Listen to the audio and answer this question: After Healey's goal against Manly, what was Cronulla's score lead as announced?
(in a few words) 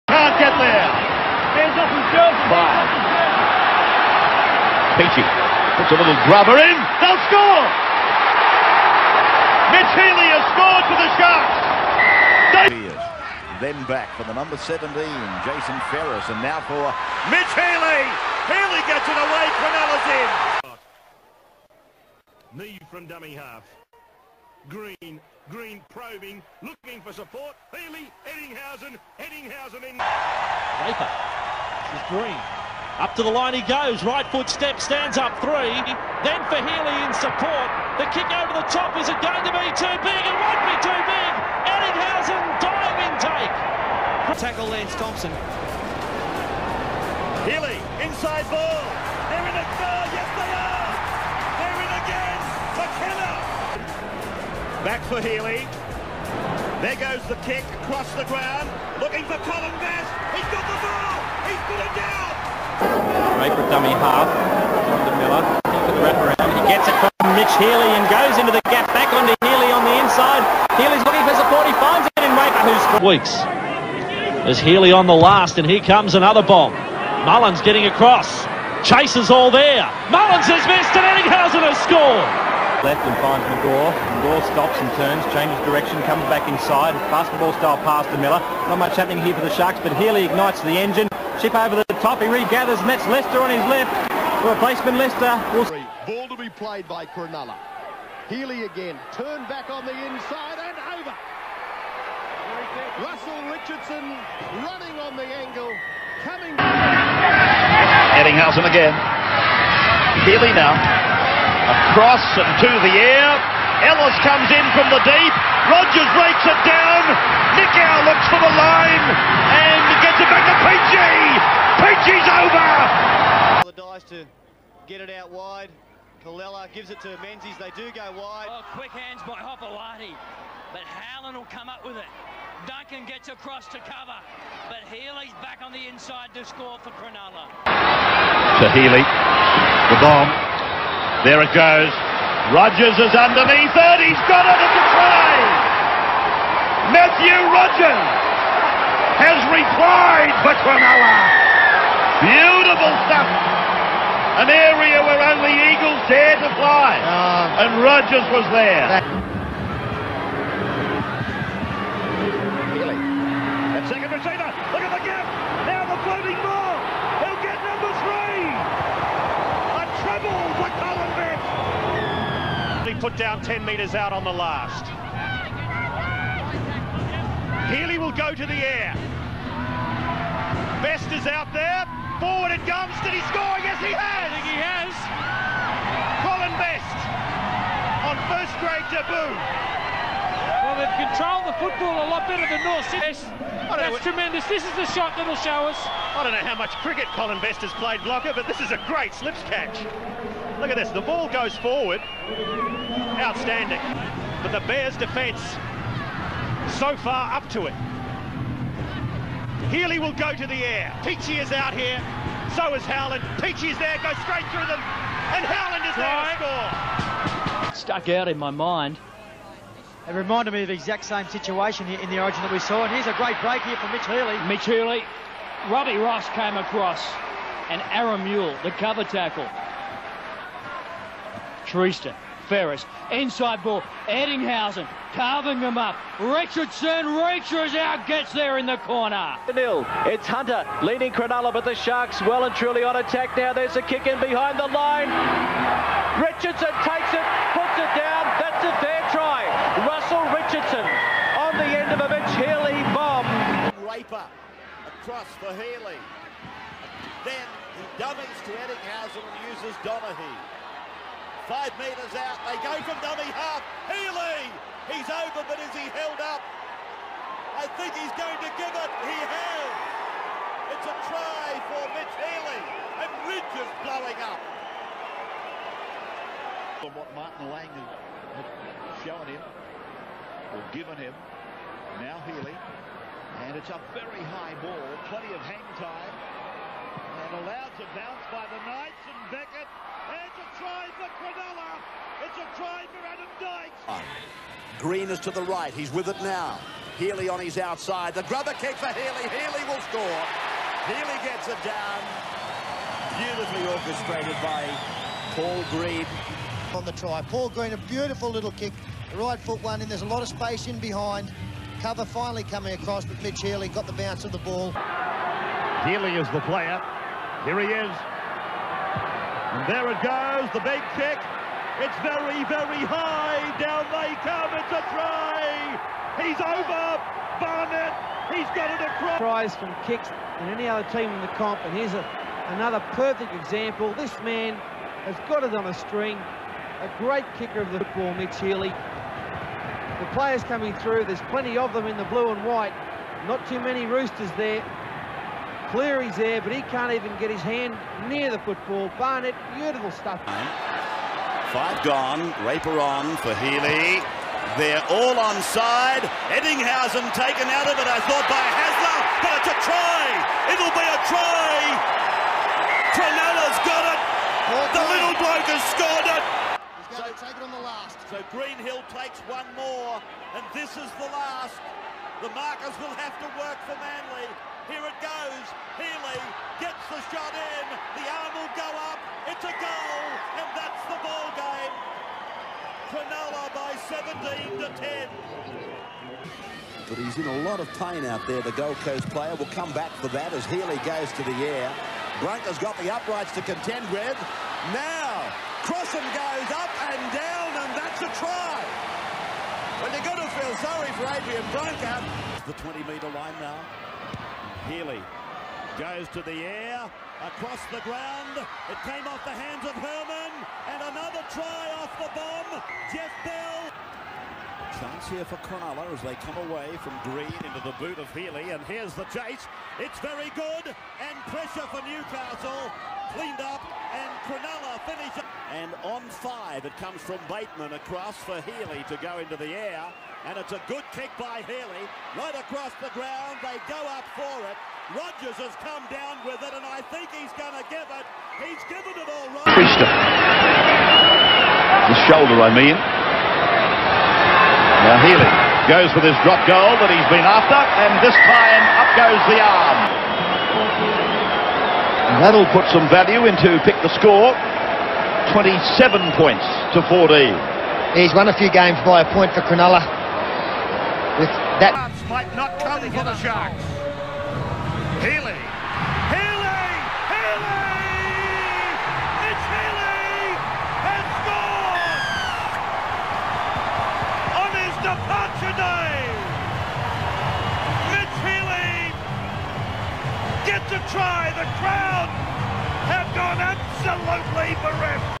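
17 to 10.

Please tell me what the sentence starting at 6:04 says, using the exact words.
The little bloke has scored it.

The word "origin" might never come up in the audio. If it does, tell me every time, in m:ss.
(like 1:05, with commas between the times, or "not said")
3:42.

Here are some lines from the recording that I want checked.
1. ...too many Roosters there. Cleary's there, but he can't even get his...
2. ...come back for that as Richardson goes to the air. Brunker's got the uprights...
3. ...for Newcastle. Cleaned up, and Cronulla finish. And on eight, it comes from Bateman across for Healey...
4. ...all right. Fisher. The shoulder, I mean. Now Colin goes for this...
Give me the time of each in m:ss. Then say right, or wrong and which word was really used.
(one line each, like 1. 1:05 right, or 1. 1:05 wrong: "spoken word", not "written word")
1. 5:43 right
2. 6:29 wrong: "Healey", not "Richardson"
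3. 7:01 wrong: "five", not "eight"
4. 7:19 wrong: "Healey", not "Colin".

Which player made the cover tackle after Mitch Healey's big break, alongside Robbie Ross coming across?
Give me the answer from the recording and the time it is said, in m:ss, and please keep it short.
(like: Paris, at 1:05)
Aaron Mule, at 3:47.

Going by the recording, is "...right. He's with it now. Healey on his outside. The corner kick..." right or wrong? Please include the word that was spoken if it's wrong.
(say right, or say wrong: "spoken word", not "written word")
wrong: "grubber", not "corner".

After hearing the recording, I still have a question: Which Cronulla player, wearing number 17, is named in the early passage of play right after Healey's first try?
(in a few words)
Jason Ferris.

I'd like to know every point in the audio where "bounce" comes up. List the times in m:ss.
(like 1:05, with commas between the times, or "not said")
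4:47, 5:13.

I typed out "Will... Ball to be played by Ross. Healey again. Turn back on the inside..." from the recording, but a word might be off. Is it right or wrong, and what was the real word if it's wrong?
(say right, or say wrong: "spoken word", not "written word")
wrong: "Cronulla", not "Ross".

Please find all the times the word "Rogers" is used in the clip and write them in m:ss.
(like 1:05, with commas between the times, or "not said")
1:55, 2:22, 2:37, 7:14.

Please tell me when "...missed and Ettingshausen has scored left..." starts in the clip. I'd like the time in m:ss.
1:20.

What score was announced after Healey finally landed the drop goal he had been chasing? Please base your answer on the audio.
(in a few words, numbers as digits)
27 to 14.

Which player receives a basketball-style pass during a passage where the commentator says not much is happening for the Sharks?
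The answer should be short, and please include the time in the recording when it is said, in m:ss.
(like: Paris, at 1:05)
Miller, at 1:28.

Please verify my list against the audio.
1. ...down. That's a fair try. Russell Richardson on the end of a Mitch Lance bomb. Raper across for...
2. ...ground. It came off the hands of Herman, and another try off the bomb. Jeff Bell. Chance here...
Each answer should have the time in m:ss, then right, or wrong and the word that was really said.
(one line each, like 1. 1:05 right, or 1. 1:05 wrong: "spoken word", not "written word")
1. 4:07 wrong: "Healey", not "Lance"
2. 6:47 right.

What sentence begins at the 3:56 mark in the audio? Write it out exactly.
Richardson reaches out, gets there in the corner.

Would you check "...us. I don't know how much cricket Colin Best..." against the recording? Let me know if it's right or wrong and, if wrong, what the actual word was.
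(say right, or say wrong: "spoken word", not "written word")
right.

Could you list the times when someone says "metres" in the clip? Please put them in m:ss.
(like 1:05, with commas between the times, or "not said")
2:53, 4:21, 6:42.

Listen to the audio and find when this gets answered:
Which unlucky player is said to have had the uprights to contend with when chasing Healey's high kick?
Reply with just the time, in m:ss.
6:41.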